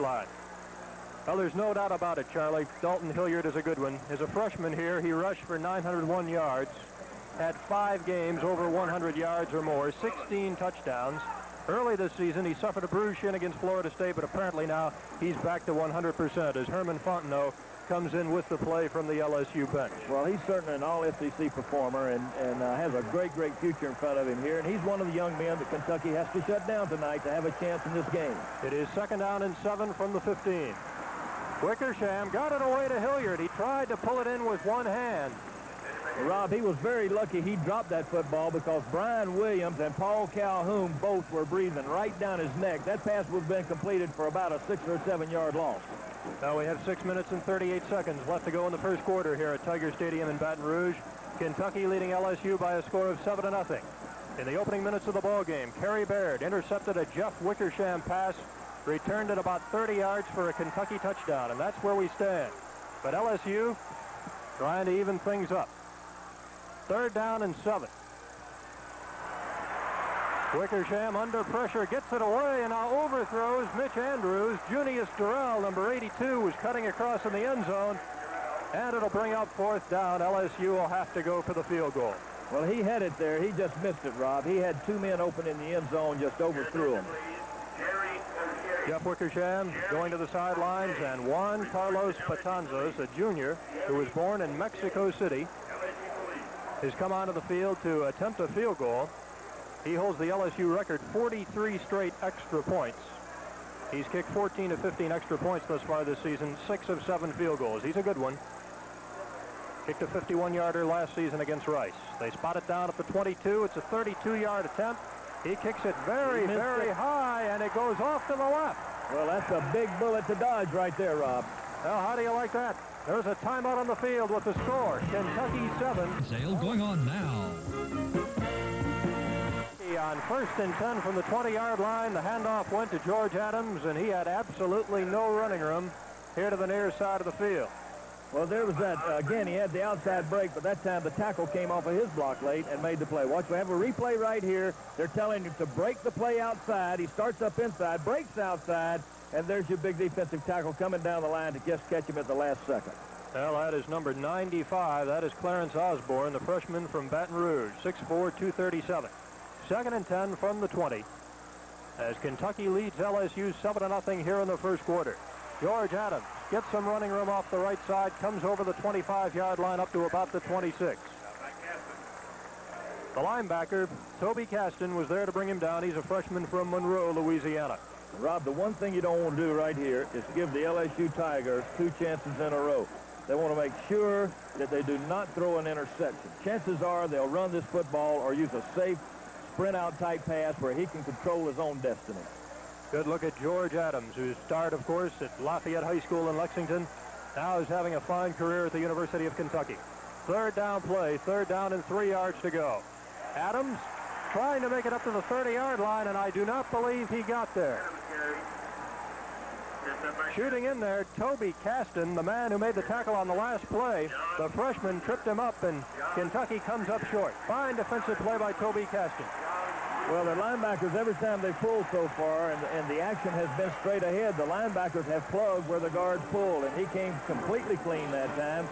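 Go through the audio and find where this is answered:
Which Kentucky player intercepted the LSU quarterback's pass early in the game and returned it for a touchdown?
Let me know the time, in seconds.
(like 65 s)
55 s.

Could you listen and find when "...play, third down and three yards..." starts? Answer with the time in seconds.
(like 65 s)
200 s.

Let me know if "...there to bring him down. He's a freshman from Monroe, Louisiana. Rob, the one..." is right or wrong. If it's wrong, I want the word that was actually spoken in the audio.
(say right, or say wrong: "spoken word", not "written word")
right.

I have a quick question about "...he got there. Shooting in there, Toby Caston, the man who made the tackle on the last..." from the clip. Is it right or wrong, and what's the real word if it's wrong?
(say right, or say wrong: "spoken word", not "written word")
right.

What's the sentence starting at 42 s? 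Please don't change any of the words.
That pass would have been completed for about a six or seven yard loss.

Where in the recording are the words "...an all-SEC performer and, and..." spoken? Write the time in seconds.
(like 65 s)
20 s.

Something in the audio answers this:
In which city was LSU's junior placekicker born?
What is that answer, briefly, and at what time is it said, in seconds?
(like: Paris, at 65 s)
Mexico City, at 94 s.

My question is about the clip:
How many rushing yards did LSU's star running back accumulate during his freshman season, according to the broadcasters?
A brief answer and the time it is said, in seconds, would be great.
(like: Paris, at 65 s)
901, at 5 s.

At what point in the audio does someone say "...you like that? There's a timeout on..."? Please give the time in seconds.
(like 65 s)
122 s.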